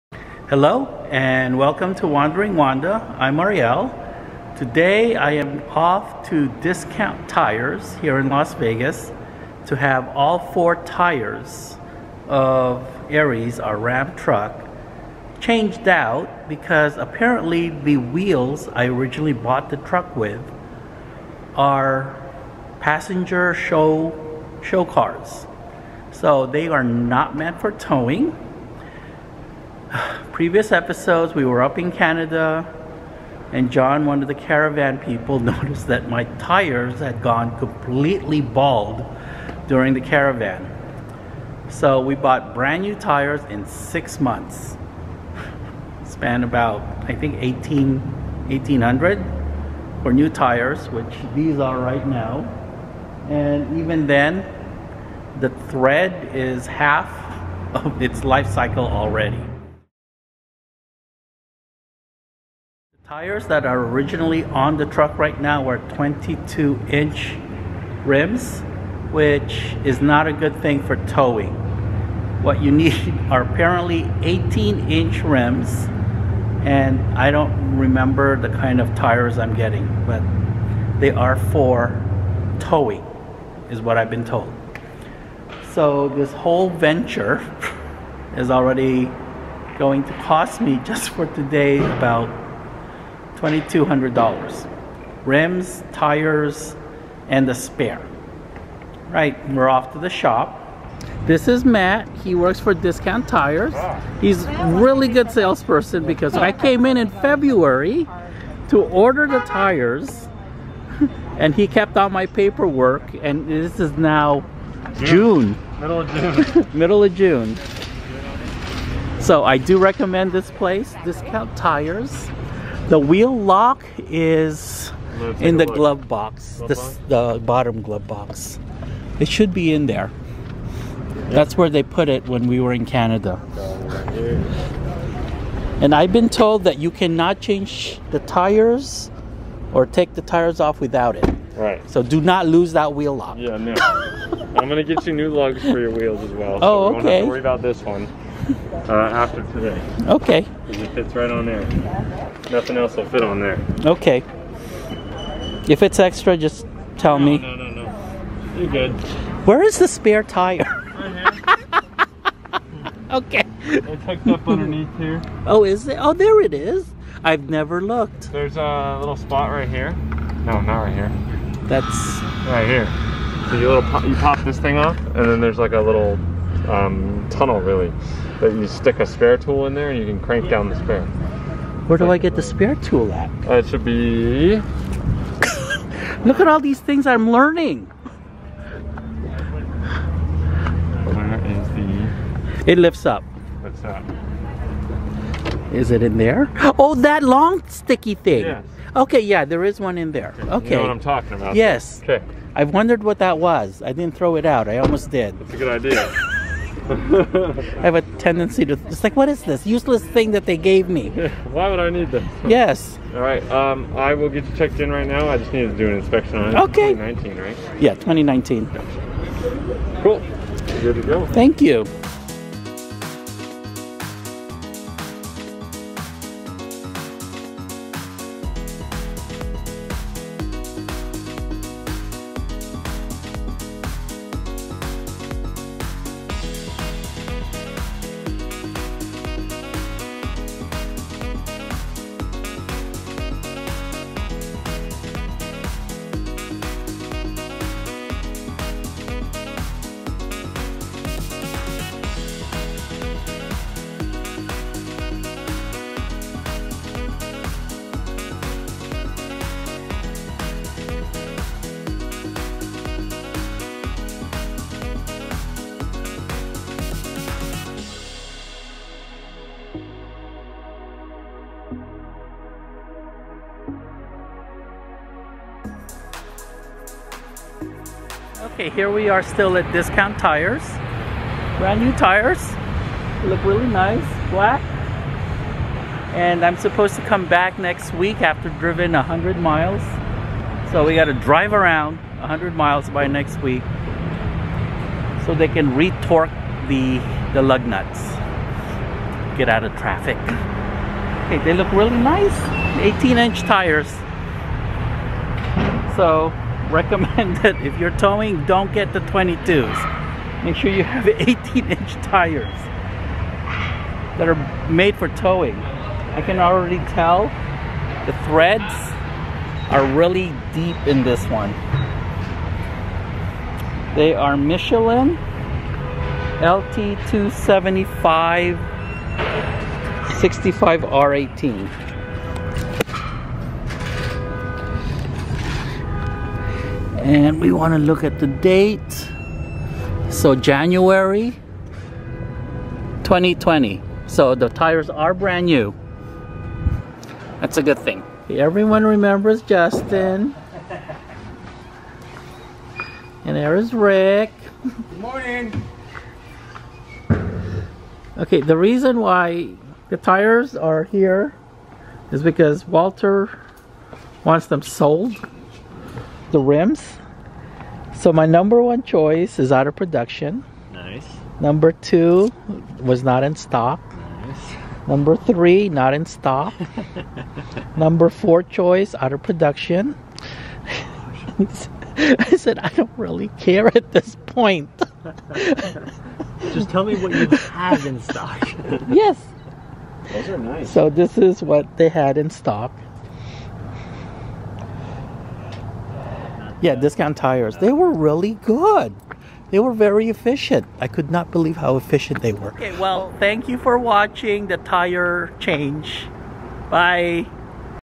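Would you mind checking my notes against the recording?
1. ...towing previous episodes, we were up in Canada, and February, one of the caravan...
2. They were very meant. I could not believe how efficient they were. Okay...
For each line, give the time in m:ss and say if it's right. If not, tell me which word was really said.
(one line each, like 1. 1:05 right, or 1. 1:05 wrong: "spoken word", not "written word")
1. 0:27 wrong: "John", not "February"
2. 6:39 wrong: "efficient", not "meant".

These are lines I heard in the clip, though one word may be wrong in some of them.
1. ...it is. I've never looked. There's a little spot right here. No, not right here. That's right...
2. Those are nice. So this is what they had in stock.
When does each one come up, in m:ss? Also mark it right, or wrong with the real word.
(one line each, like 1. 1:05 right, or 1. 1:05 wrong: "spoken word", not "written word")
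1. 2:46 right
2. 6:30 right.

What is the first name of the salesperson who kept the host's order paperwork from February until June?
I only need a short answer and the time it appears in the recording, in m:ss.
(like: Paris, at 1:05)
Matt, at 1:41.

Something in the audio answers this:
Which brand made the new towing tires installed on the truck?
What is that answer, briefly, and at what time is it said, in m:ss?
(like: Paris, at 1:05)
Michelin, at 5:24.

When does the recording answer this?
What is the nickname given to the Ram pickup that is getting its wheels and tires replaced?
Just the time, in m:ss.
0:13.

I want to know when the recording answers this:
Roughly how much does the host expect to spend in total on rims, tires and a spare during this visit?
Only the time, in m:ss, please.
1:33.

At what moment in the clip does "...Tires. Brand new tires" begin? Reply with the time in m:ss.
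4:40.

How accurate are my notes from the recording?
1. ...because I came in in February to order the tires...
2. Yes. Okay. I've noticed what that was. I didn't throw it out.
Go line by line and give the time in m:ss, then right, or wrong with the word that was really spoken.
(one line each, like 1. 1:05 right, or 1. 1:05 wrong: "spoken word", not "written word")
1. 1:46 right
2. 3:21 wrong: "wondered", not "noticed".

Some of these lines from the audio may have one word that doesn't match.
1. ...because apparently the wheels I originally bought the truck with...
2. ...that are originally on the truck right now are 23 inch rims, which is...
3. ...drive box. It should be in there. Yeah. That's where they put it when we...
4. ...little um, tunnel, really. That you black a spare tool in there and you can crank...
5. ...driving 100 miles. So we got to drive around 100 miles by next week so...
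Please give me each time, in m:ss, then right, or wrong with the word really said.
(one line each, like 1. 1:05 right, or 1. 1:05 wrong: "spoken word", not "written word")
1. 0:16 right
2. 1:03 wrong: "22", not "23"
3. 2:07 wrong: "glove", not "drive"
4. 2:55 wrong: "stick", not "black"
5. 4:48 right.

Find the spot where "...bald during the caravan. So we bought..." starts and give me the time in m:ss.
0:38.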